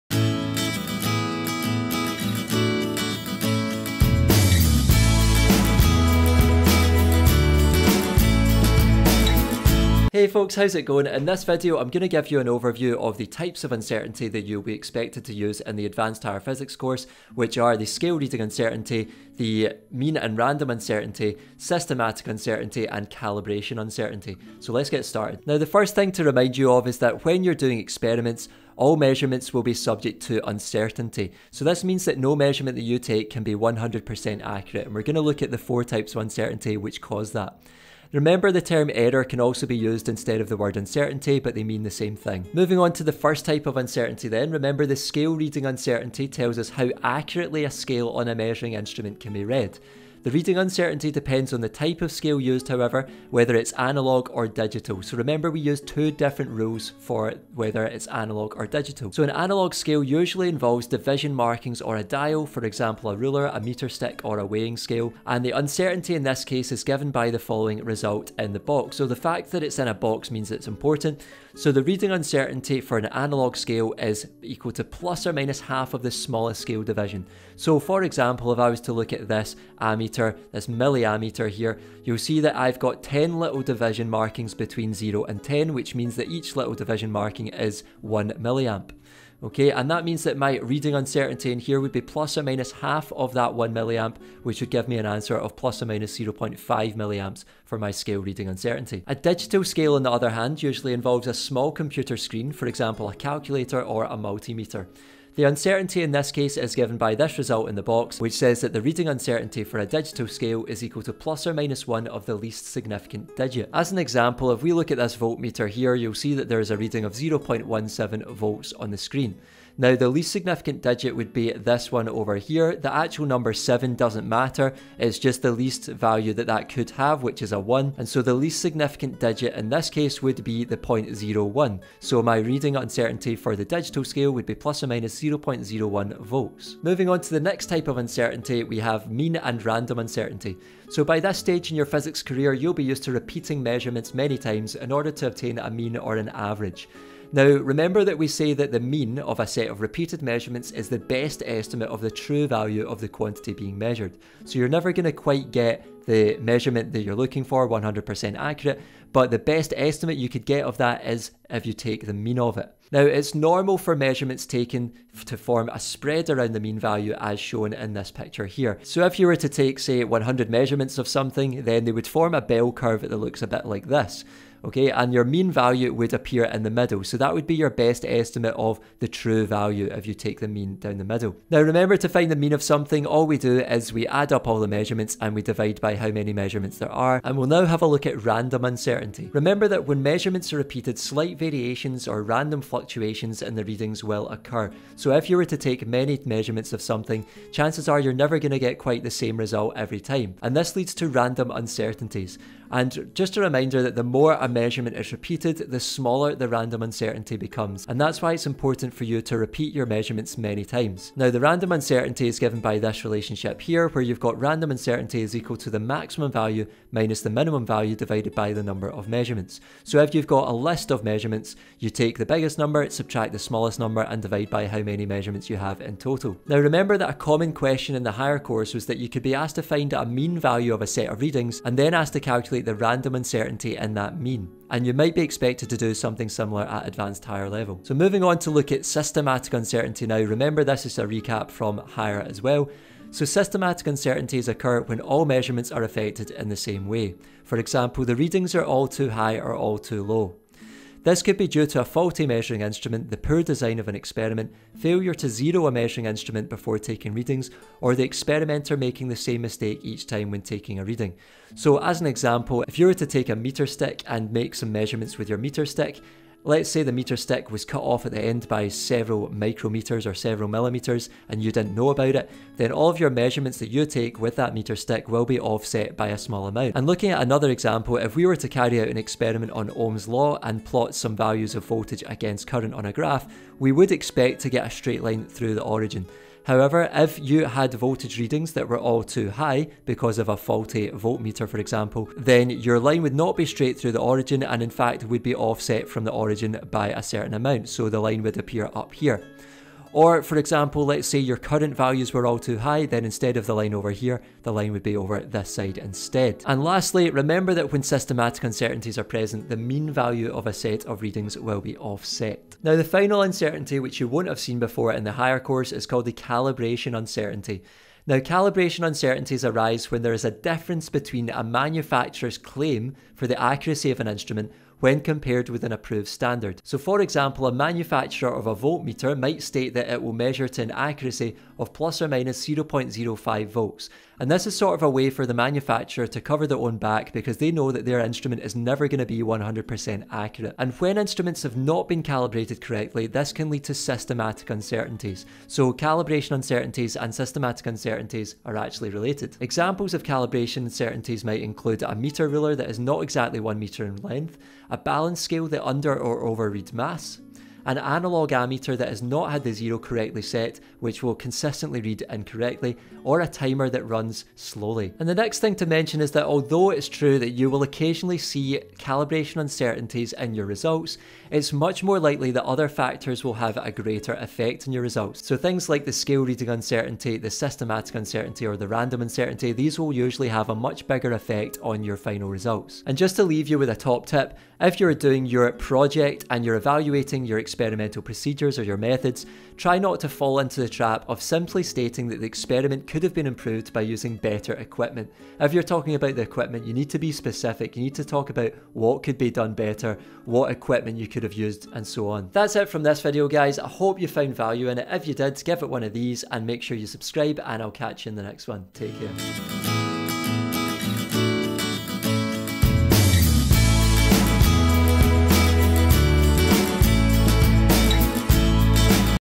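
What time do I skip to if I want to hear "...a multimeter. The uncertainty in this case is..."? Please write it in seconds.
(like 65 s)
104 s.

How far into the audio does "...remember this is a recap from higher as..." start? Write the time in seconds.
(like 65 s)
240 s.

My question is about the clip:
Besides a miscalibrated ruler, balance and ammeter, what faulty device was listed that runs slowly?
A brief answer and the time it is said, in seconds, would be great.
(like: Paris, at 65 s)
A timer, at 363 s.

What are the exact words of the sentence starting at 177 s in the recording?
So that would be your best estimate of the true value if you take the mean down the middle.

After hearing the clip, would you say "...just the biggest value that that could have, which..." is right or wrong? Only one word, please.
wrong.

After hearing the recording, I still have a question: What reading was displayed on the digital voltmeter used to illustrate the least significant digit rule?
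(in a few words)
0.17 volts.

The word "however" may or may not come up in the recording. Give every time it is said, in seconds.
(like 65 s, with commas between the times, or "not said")
52 s, 286 s.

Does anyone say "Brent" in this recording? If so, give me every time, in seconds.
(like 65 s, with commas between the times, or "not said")
not said.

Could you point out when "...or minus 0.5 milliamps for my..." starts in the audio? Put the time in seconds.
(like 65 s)
95 s.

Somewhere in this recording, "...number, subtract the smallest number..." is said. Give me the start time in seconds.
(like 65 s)
222 s.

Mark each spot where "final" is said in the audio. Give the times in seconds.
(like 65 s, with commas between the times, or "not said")
312 s, 381 s.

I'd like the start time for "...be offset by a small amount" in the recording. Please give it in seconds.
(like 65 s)
275 s.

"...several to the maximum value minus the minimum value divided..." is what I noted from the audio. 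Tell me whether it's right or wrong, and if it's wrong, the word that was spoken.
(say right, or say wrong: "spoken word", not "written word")
wrong: "equal", not "several".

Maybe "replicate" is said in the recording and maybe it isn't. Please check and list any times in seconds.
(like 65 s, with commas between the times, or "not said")
not said.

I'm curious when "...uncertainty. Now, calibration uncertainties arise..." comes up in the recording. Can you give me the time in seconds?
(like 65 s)
316 s.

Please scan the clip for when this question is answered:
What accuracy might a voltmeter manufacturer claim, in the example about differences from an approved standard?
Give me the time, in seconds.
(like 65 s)
331 s.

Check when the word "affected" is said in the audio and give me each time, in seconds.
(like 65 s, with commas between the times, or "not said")
245 s.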